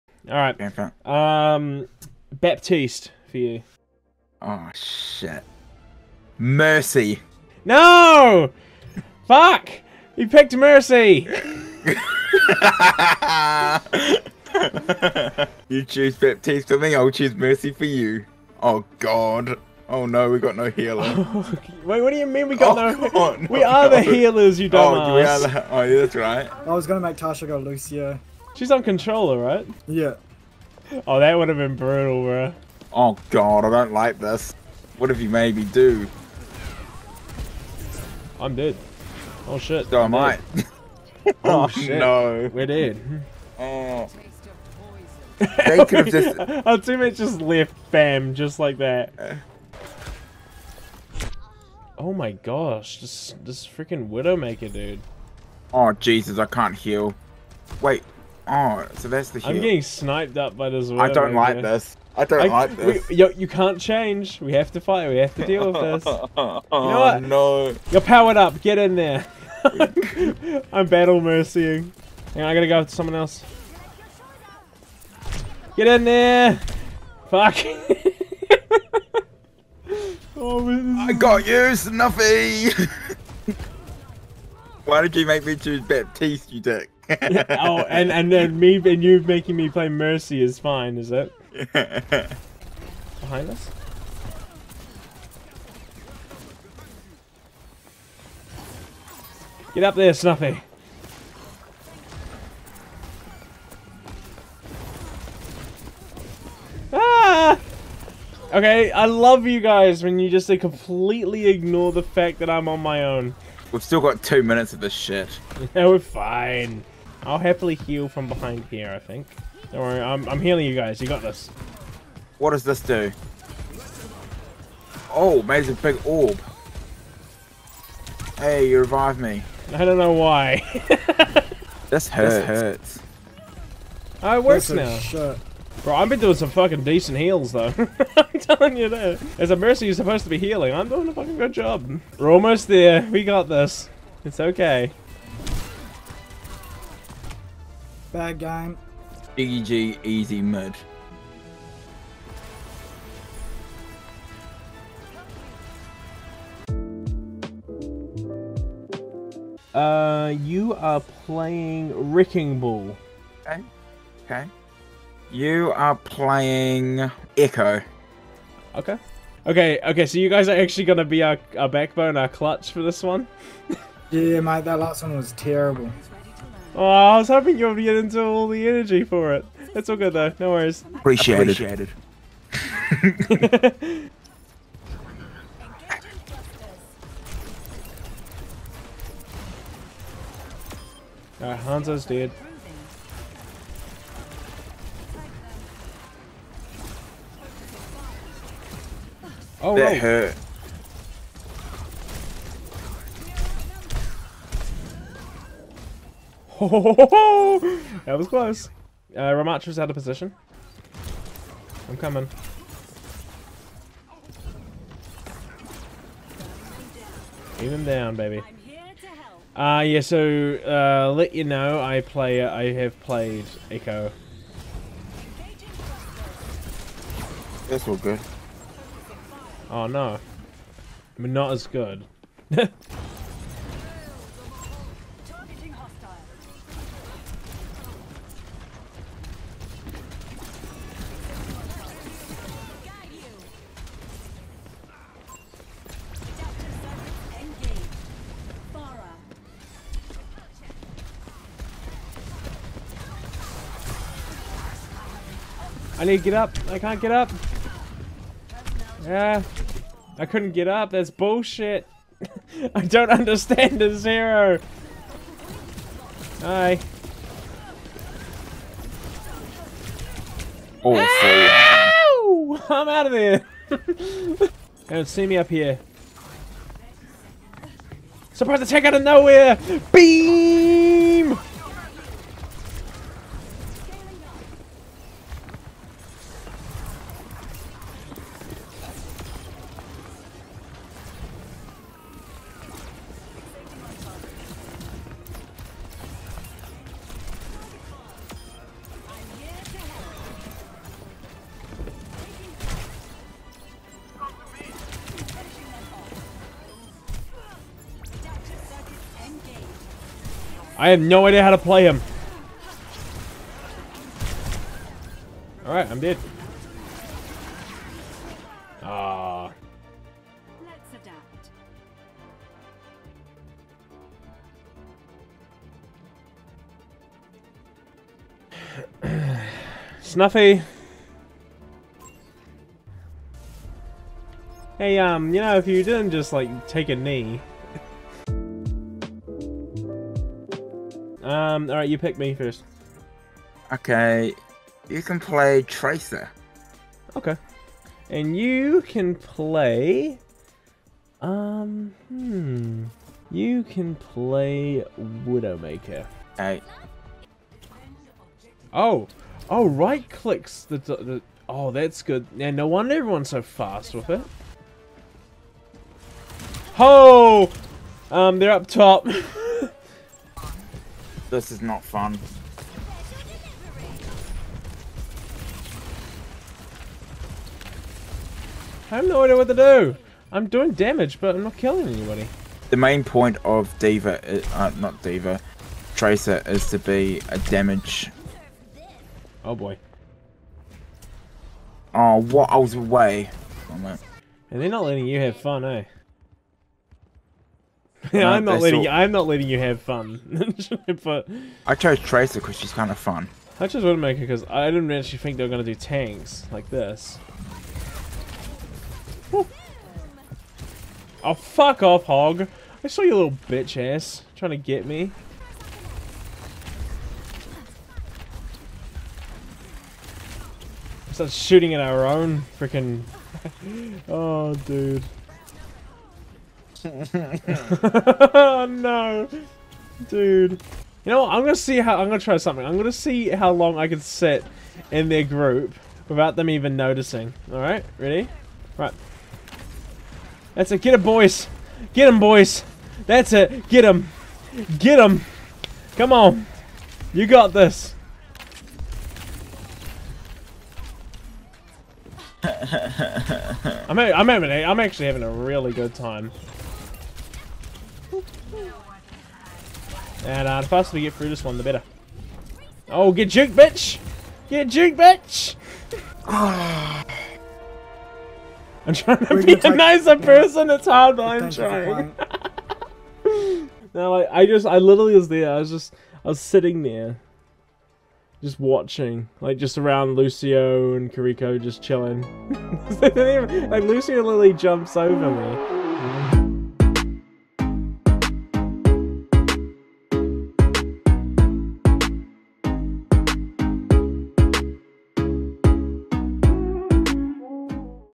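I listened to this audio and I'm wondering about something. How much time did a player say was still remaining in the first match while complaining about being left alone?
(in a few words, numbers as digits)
two minutes.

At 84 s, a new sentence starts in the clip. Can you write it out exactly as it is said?
Why did you make me choose Baptiste, you dick?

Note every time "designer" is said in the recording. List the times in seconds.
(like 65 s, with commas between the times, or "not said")
not said.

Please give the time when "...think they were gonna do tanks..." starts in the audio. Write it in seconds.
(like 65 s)
405 s.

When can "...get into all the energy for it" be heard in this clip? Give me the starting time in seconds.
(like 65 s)
177 s.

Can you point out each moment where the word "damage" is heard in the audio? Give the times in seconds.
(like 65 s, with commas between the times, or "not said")
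380 s, 387 s.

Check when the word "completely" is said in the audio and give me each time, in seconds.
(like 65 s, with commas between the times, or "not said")
110 s.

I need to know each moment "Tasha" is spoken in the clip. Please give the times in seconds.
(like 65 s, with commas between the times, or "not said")
27 s.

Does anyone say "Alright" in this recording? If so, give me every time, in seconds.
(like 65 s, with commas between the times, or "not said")
191 s, 315 s, 437 s.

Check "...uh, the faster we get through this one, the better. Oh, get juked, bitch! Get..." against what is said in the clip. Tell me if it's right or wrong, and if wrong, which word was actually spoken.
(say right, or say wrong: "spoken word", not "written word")
right.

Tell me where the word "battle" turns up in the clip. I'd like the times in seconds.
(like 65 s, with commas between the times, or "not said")
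70 s.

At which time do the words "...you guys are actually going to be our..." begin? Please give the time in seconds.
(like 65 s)
170 s.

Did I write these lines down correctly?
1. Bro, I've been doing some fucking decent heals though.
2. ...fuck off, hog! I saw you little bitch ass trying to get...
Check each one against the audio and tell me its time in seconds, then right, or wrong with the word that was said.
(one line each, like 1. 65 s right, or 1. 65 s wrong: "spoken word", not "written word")
1. 135 s right
2. 411 s right.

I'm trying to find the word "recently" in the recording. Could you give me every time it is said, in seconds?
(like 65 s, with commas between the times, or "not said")
not said.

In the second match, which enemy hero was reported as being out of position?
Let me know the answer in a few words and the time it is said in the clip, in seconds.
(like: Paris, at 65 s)
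Ramattra, at 209 s.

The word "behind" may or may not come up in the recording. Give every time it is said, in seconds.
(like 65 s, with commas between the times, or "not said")
93 s, 118 s.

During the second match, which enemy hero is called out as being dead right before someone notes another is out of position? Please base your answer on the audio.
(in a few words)
Hanzo.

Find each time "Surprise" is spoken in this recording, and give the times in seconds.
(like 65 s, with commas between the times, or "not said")
278 s.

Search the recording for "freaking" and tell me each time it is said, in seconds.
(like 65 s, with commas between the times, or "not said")
53 s, 422 s.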